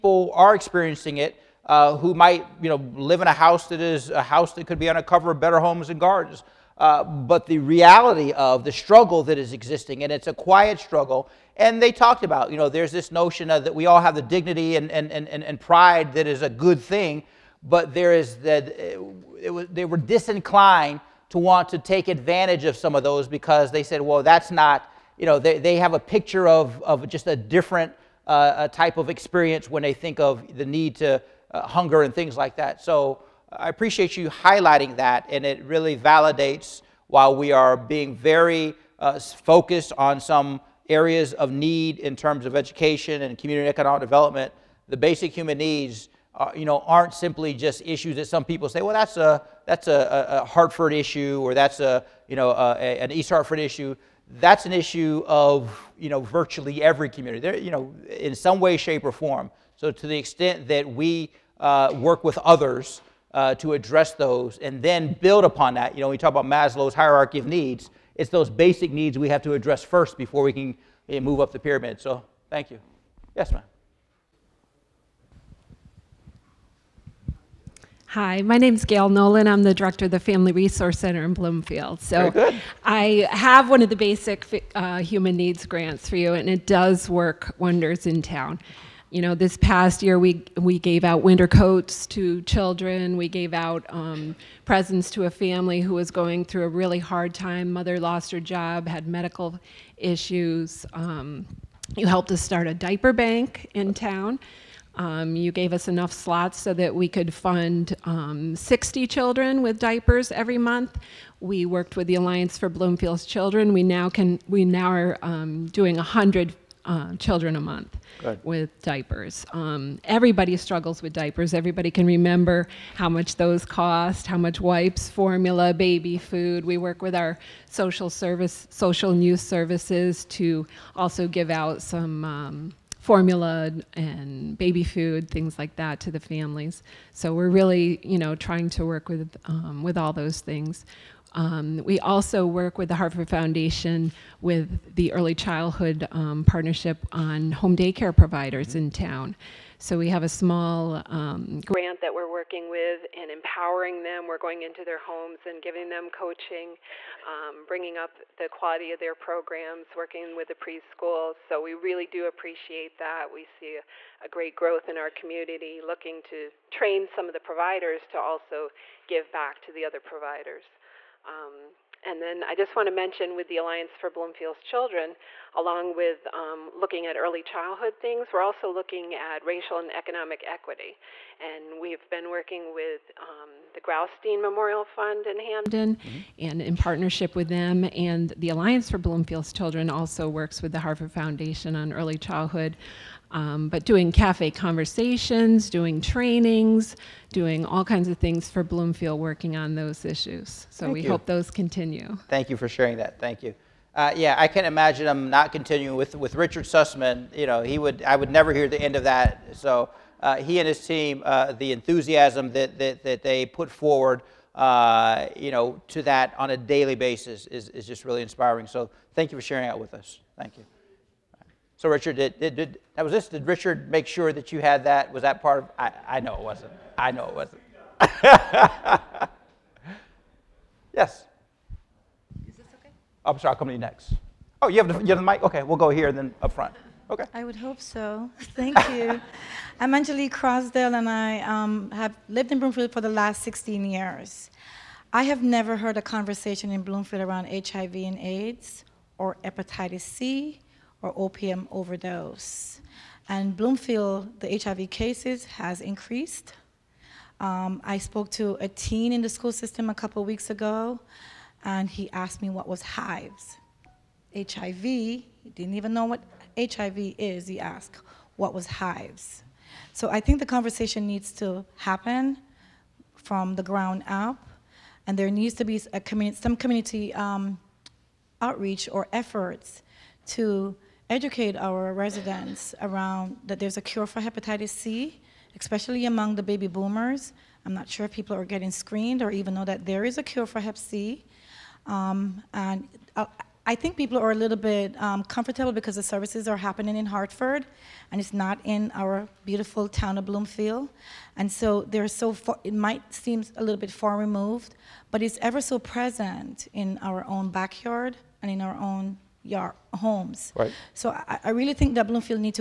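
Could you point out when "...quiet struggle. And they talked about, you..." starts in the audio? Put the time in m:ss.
0:10.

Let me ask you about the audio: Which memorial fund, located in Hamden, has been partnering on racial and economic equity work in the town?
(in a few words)
Graustein Memorial Fund.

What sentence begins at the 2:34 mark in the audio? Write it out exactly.
We're going into their homes and giving them coaching, um, bringing up the quality of their programs, working with the preschools.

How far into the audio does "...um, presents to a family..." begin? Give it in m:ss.
1:33.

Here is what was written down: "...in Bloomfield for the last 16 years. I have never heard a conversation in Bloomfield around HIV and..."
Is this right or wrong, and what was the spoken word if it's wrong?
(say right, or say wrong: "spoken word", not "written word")
right.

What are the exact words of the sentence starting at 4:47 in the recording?
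I'm not sure if people are getting screened or even know that there is a cure for hep C.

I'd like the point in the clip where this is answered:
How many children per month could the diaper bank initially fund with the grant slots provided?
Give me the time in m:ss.
1:48.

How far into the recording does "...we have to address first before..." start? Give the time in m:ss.
1:09.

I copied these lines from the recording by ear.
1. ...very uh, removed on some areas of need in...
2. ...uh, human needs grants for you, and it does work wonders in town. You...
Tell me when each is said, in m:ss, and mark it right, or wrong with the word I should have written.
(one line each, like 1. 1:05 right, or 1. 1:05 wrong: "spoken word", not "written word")
1. 0:38 wrong: "focused", not "removed"
2. 1:24 right.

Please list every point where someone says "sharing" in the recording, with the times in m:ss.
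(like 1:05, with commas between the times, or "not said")
3:22, 3:39.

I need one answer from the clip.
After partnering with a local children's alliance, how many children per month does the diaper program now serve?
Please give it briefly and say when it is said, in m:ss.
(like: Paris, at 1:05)
100, at 1:55.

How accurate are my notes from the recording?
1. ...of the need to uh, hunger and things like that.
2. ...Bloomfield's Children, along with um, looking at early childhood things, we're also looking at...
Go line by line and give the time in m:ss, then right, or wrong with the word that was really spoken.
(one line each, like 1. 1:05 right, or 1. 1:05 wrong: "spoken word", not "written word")
1. 0:30 right
2. 2:54 right.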